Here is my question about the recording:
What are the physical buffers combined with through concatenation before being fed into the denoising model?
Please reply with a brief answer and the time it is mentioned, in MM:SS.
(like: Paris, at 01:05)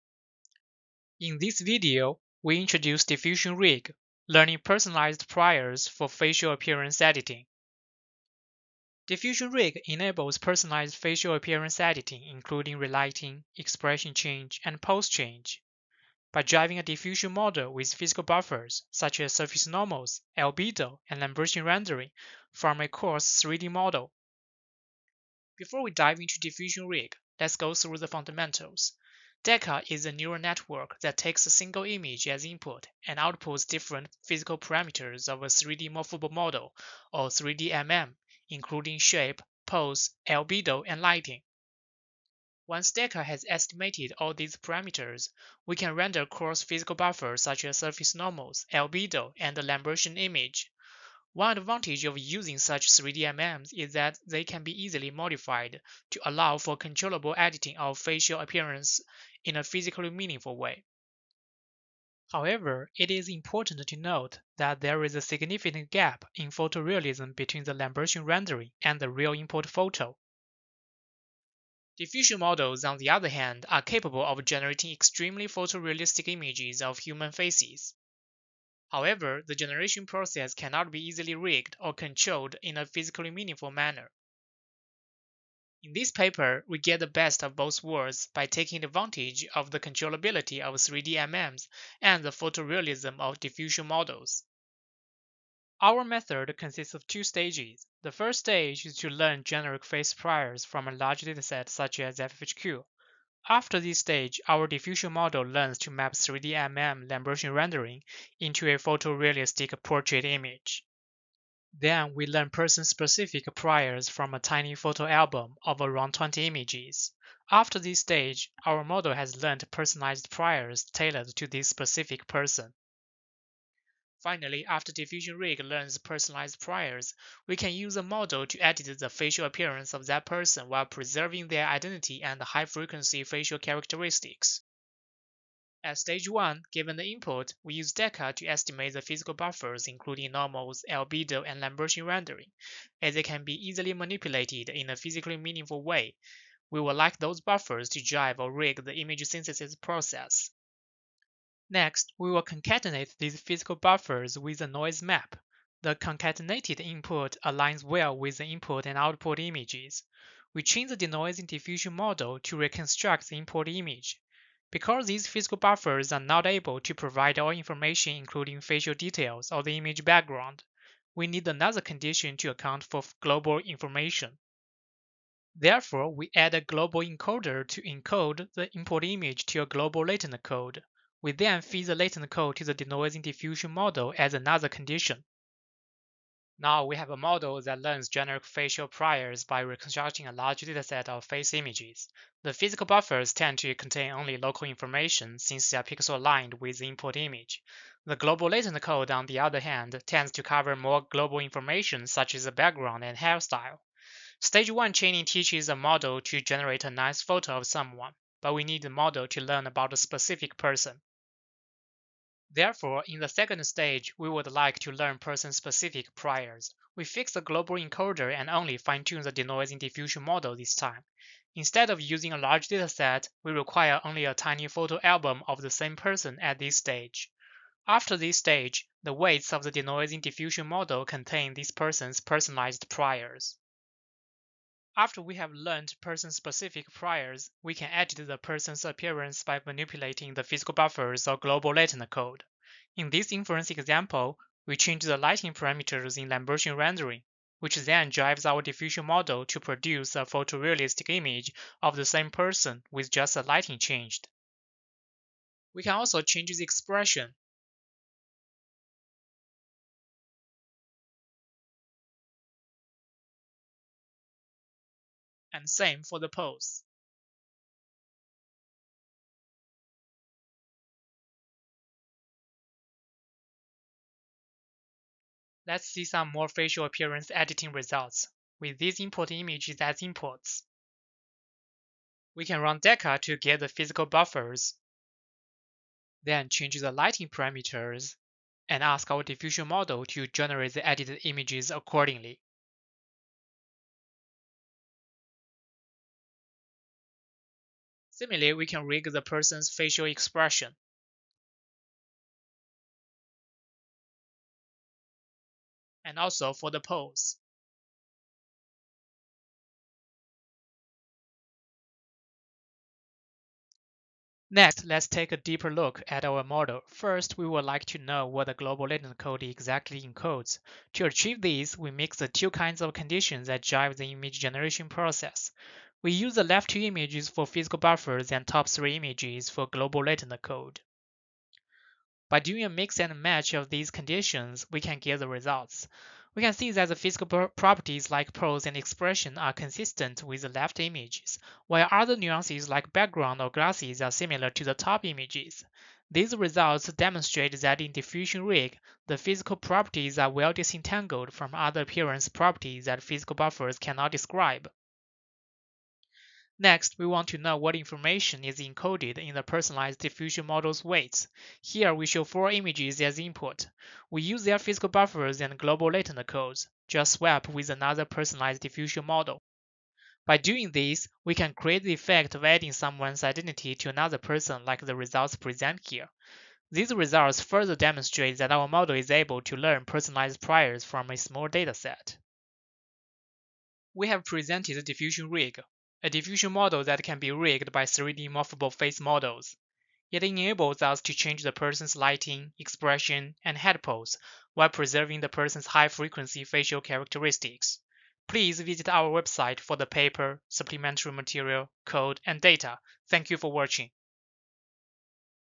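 A noise map, at 02:34.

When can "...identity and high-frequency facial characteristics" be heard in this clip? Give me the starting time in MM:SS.
02:11.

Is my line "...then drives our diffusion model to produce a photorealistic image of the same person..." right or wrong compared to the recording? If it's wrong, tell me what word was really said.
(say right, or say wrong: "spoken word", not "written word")
right.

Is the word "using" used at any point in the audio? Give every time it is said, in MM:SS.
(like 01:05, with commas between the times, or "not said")
00:52, 03:42.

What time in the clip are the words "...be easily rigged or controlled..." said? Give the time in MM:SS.
01:20.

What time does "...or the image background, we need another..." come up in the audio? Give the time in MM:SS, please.
02:49.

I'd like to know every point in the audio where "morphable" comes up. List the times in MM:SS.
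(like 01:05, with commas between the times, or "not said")
00:35, 06:28.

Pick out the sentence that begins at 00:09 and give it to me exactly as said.
Diffusion Rig enables personalized facial appearance editing, including relighting, expression change, and pose change.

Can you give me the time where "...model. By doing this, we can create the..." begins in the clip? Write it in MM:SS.
06:09.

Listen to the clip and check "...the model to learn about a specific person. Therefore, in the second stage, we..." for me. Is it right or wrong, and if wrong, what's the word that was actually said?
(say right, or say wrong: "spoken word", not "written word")
right.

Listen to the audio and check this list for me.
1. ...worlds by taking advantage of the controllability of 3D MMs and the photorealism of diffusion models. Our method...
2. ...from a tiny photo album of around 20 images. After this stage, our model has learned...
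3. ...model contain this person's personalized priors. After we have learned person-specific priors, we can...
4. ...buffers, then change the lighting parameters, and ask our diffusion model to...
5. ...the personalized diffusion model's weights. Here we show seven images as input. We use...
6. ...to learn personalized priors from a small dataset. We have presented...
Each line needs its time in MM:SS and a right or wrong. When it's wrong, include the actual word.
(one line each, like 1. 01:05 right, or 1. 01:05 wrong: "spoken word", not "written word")
1. 01:27 right
2. 01:54 right
3. 03:50 right
4. 04:44 right
5. 05:59 wrong: "four", not "seven"
6. 06:19 right.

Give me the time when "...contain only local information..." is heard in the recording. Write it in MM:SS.
03:13.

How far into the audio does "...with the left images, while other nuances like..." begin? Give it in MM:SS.
05:40.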